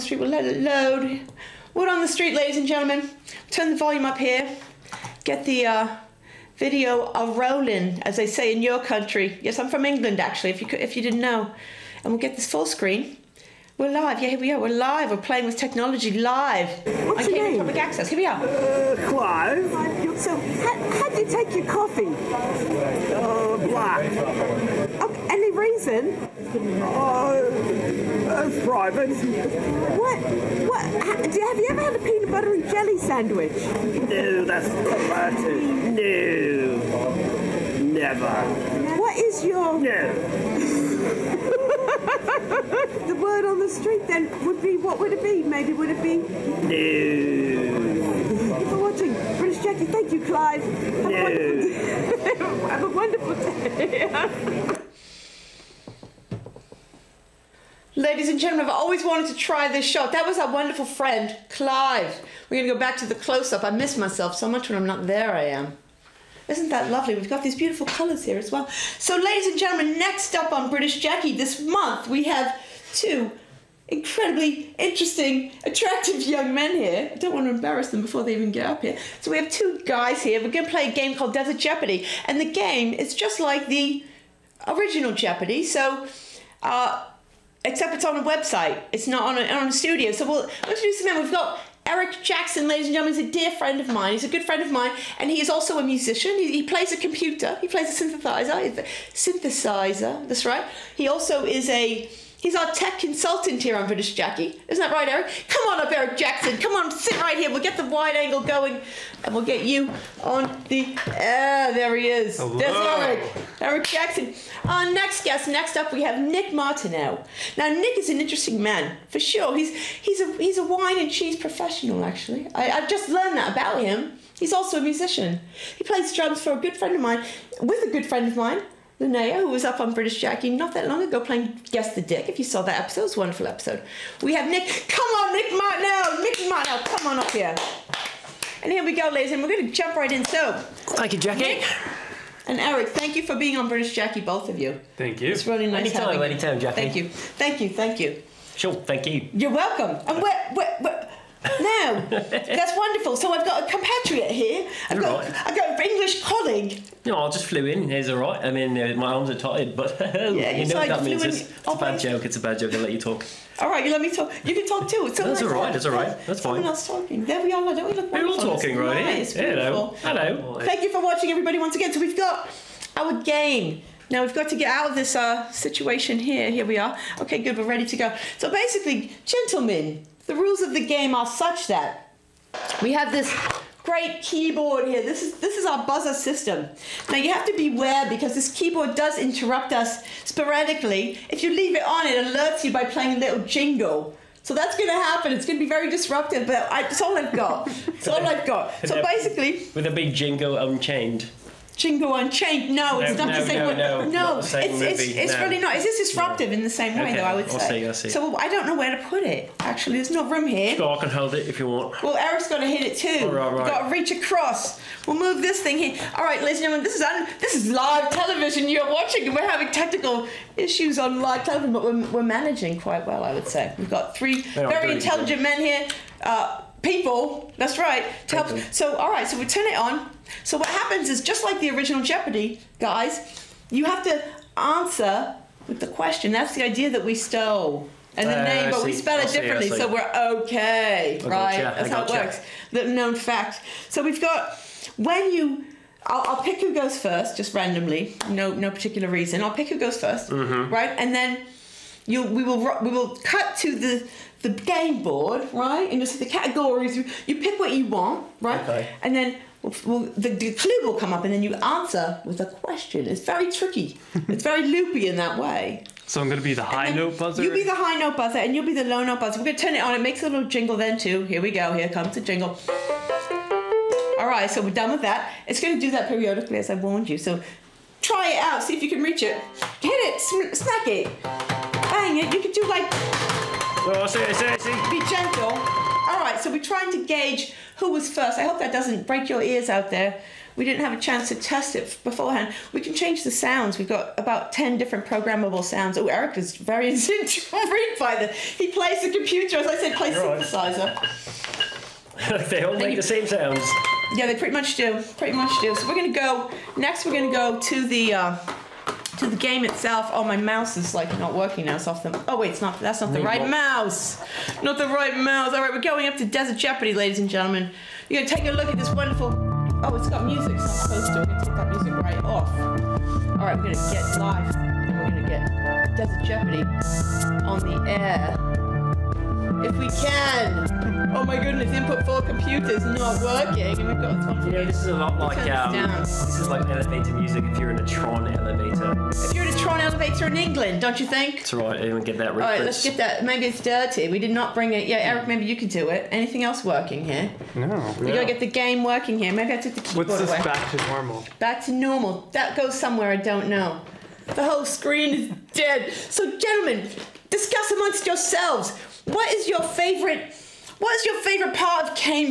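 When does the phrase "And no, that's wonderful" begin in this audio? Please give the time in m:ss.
2:30.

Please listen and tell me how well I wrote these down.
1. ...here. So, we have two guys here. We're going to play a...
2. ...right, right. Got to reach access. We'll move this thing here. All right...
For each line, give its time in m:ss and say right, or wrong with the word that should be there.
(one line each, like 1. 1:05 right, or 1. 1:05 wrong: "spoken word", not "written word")
1. 1:18 right
2. 3:33 wrong: "across", not "access".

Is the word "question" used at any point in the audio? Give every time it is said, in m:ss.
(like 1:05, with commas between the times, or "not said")
3:55, 4:22.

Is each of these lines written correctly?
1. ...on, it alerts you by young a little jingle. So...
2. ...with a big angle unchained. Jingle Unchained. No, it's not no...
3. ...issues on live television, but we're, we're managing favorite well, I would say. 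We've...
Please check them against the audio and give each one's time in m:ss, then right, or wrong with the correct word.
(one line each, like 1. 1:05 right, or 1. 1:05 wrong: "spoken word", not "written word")
1. 3:11 wrong: "playing", not "young"
2. 3:19 wrong: "jingle", not "angle"
3. 3:40 wrong: "quite", not "favorite".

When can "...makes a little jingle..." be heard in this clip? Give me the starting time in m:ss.
4:30.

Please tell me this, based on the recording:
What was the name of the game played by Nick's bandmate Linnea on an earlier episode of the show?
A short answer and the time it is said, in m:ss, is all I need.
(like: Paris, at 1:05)
Guess the Dick, at 2:11.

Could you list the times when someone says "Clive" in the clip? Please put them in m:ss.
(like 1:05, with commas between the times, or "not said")
0:19, 0:50, 1:01.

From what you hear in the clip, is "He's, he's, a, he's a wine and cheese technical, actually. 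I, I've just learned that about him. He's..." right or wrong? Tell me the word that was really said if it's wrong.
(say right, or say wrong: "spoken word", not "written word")
wrong: "professional", not "technical".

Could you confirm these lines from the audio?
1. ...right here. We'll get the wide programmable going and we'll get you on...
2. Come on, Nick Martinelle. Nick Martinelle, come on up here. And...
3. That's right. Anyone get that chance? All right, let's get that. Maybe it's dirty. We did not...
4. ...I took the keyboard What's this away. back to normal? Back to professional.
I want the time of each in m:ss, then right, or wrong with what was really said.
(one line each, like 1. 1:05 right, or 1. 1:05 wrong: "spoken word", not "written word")
1. 1:47 wrong: "angle", not "programmable"
2. 2:14 right
3. 5:41 wrong: "reference", not "chance"
4. 5:49 wrong: "normal", not "professional".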